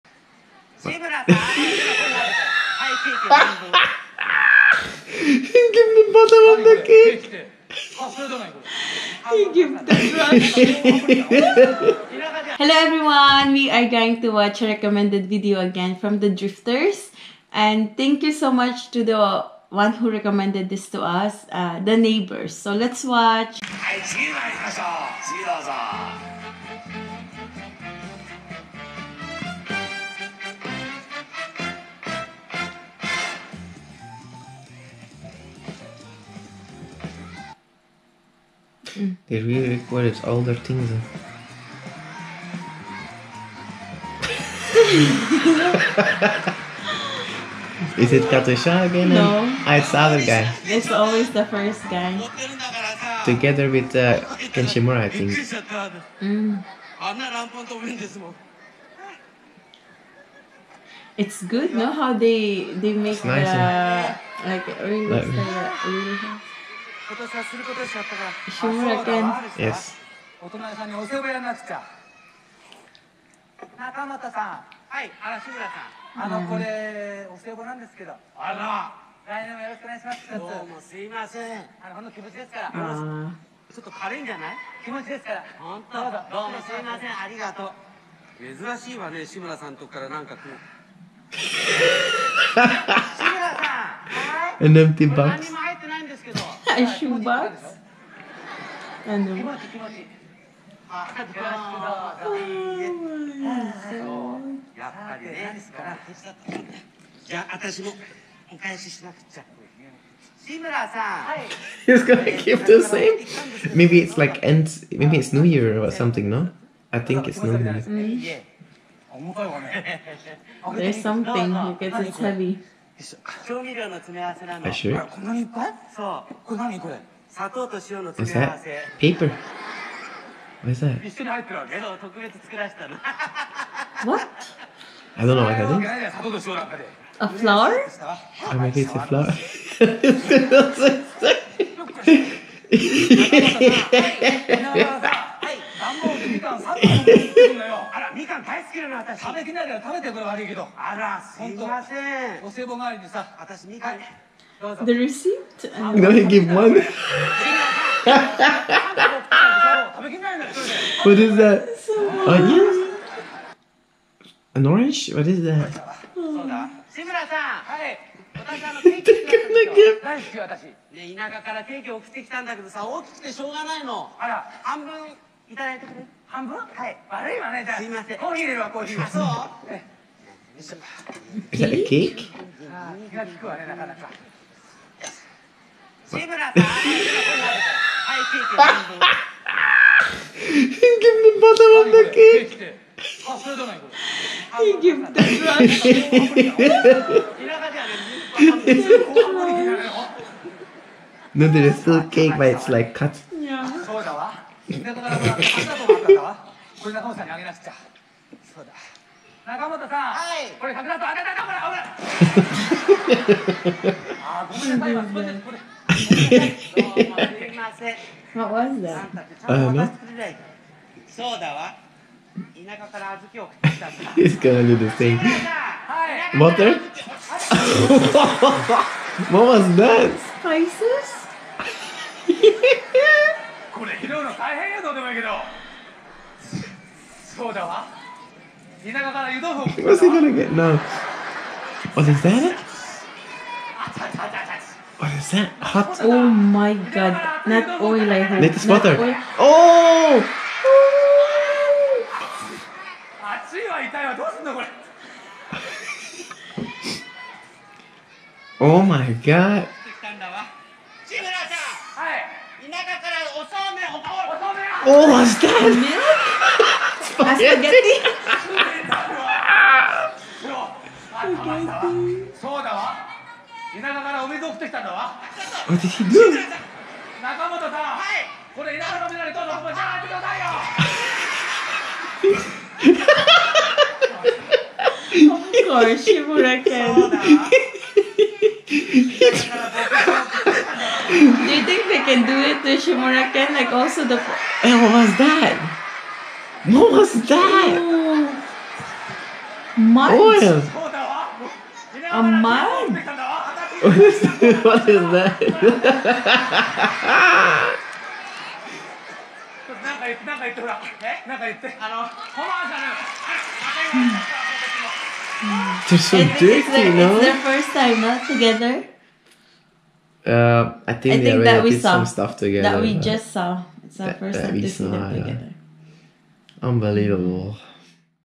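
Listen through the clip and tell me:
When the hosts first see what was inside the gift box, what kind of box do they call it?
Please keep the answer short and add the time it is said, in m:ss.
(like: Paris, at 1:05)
a shoebox, at 1:36.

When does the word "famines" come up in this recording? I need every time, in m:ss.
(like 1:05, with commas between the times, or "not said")
not said.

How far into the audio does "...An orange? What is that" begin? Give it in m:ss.
2:44.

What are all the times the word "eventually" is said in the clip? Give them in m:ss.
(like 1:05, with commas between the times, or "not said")
not said.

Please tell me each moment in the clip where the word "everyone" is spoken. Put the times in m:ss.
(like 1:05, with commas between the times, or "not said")
0:12.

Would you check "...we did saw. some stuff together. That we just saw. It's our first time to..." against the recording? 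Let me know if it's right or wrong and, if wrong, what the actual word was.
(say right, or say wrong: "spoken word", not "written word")
right.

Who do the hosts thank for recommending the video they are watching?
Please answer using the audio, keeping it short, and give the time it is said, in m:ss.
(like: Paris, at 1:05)
the neighbors, at 0:21.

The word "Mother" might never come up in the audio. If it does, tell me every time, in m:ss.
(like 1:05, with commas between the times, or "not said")
3:46.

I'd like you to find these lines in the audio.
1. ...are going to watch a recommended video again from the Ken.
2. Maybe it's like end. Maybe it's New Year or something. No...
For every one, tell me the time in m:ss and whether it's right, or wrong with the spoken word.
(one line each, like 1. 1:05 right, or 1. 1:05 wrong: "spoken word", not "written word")
1. 0:13 wrong: "Drifters", not "Ken"
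2. 1:53 right.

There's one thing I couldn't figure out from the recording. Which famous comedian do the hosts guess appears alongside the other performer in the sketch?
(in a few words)
Ken Shimura.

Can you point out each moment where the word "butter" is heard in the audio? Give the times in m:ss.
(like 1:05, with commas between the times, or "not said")
0:06, 4:08.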